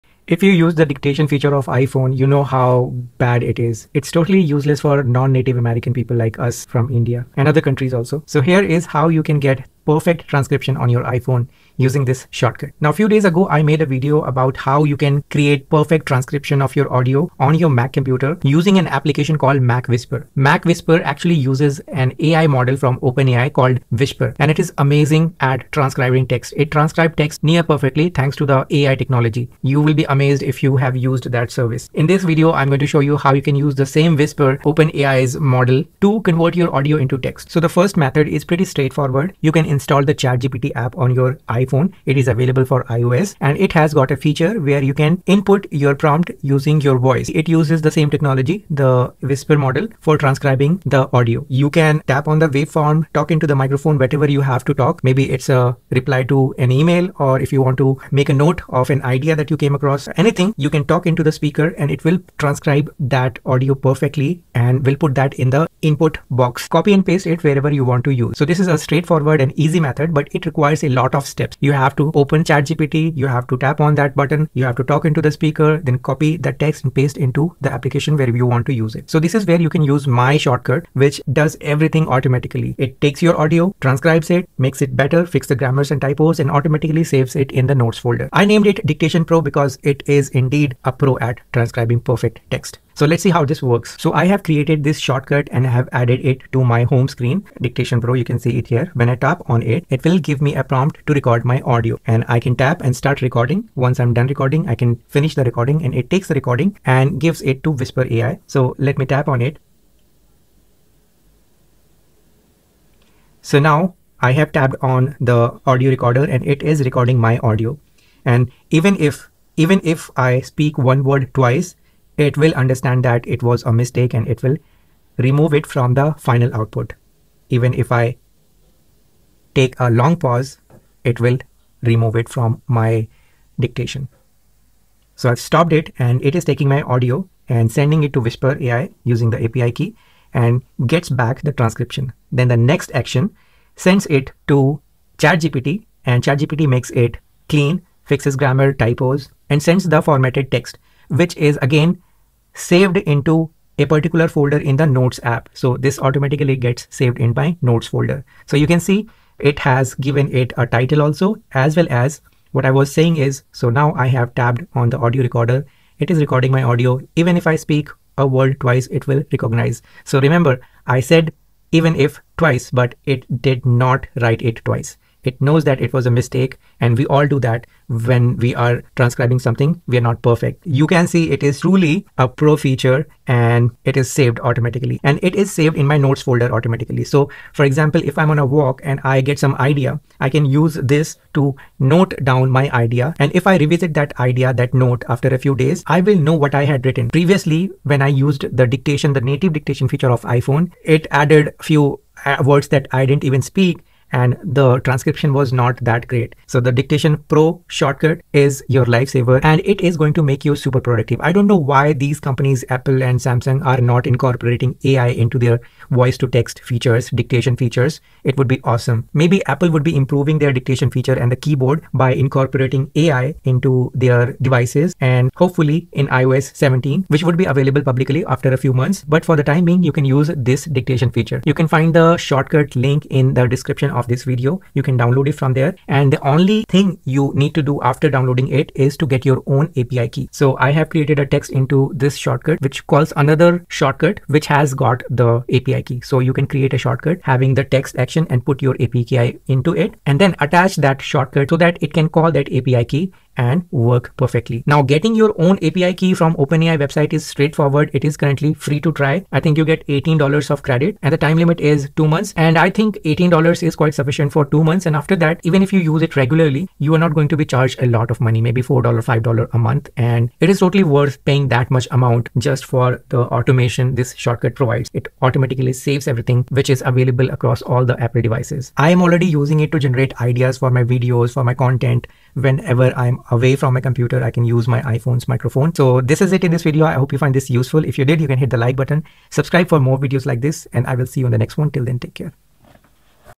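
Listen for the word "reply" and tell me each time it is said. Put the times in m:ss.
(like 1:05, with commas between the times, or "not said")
0:55.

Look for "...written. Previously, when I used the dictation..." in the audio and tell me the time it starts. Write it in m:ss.
3:16.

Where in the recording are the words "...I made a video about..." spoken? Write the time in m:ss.
0:13.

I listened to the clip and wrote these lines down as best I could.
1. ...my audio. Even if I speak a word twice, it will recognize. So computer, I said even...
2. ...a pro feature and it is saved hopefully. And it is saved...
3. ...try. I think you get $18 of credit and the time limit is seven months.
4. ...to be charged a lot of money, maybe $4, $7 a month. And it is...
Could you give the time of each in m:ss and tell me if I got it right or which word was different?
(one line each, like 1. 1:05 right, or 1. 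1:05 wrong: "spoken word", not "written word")
1. 2:46 wrong: "remember", not "computer"
2. 3:02 wrong: "automatically", not "hopefully"
3. 4:18 wrong: "two", not "seven"
4. 4:27 wrong: "5", not "7".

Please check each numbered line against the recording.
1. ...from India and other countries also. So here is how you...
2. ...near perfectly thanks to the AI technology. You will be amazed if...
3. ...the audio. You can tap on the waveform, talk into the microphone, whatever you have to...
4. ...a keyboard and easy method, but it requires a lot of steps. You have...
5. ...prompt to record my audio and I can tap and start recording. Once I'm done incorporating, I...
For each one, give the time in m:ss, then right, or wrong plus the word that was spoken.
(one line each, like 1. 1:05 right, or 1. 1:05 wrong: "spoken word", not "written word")
1. 0:06 right
2. 0:27 right
3. 0:50 right
4. 1:08 wrong: "straightforward", not "keyboard"
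5. 1:40 wrong: "recording", not "incorporating".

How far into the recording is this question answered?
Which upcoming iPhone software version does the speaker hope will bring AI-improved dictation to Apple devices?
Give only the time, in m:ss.
3:46.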